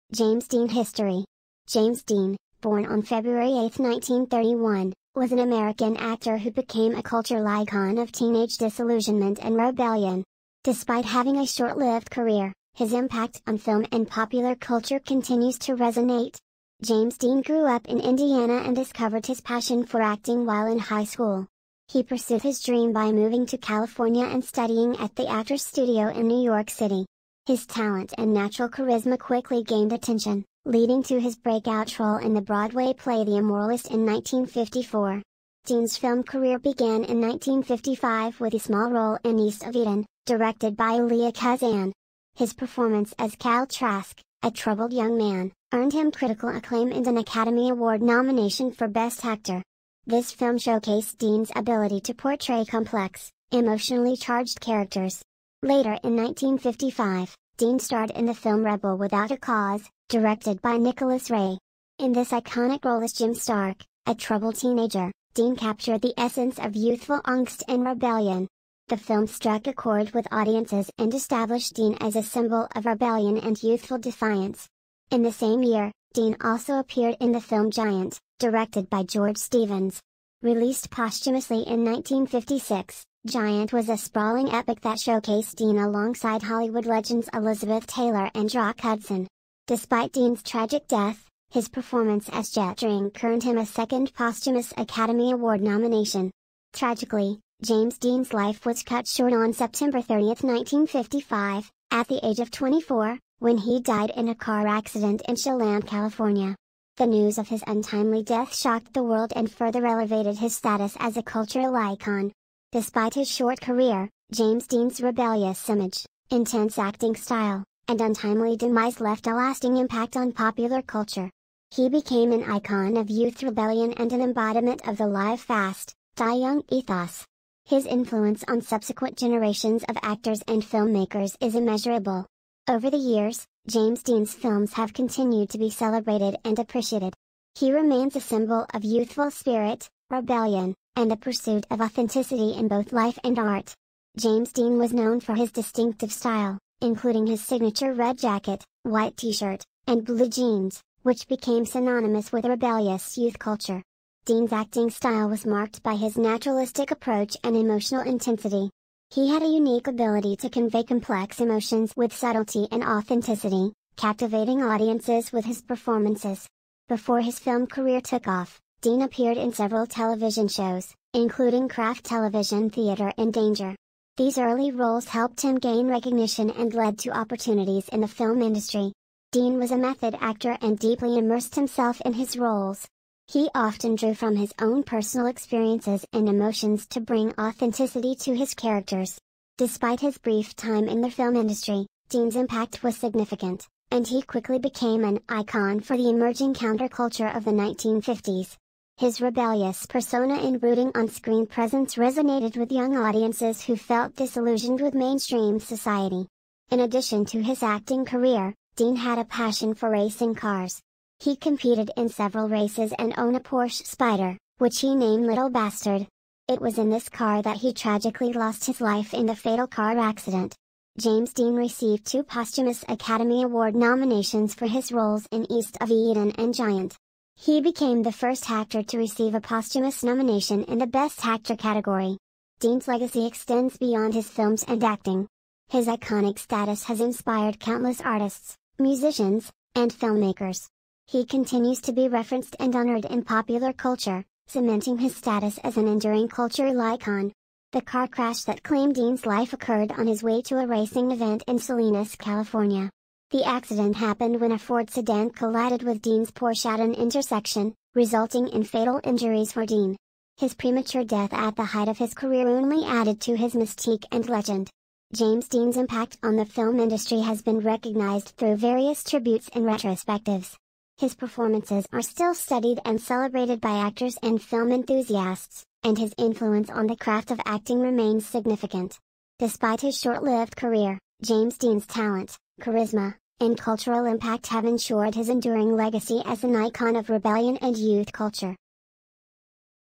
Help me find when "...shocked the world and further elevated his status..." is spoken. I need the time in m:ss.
1:48.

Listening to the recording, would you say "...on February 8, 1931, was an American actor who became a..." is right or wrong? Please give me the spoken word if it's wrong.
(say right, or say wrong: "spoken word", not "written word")
right.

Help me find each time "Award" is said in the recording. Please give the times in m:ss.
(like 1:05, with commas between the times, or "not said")
0:47, 1:35, 3:43.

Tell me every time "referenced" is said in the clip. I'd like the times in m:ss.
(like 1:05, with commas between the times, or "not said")
4:02.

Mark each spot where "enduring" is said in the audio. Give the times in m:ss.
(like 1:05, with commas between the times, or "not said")
4:05, 4:45.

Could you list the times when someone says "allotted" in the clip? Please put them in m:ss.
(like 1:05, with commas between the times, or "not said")
not said.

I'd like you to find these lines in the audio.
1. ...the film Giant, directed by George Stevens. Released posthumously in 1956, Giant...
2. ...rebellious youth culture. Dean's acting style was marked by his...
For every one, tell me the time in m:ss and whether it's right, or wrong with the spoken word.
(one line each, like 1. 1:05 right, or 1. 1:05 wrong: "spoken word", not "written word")
1. 1:17 right
2. 2:32 right.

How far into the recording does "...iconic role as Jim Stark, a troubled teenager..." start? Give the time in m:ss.
1:02.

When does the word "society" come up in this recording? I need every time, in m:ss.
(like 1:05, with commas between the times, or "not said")
3:25.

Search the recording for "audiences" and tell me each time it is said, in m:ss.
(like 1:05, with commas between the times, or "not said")
1:10, 2:44, 3:22.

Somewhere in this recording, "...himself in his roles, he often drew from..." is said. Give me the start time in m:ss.
3:01.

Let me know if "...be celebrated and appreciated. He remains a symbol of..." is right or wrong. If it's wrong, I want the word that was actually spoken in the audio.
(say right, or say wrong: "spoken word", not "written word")
right.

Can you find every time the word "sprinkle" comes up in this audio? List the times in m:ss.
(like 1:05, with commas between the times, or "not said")
not said.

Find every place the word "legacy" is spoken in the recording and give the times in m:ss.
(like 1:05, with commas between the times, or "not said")
3:52, 4:45.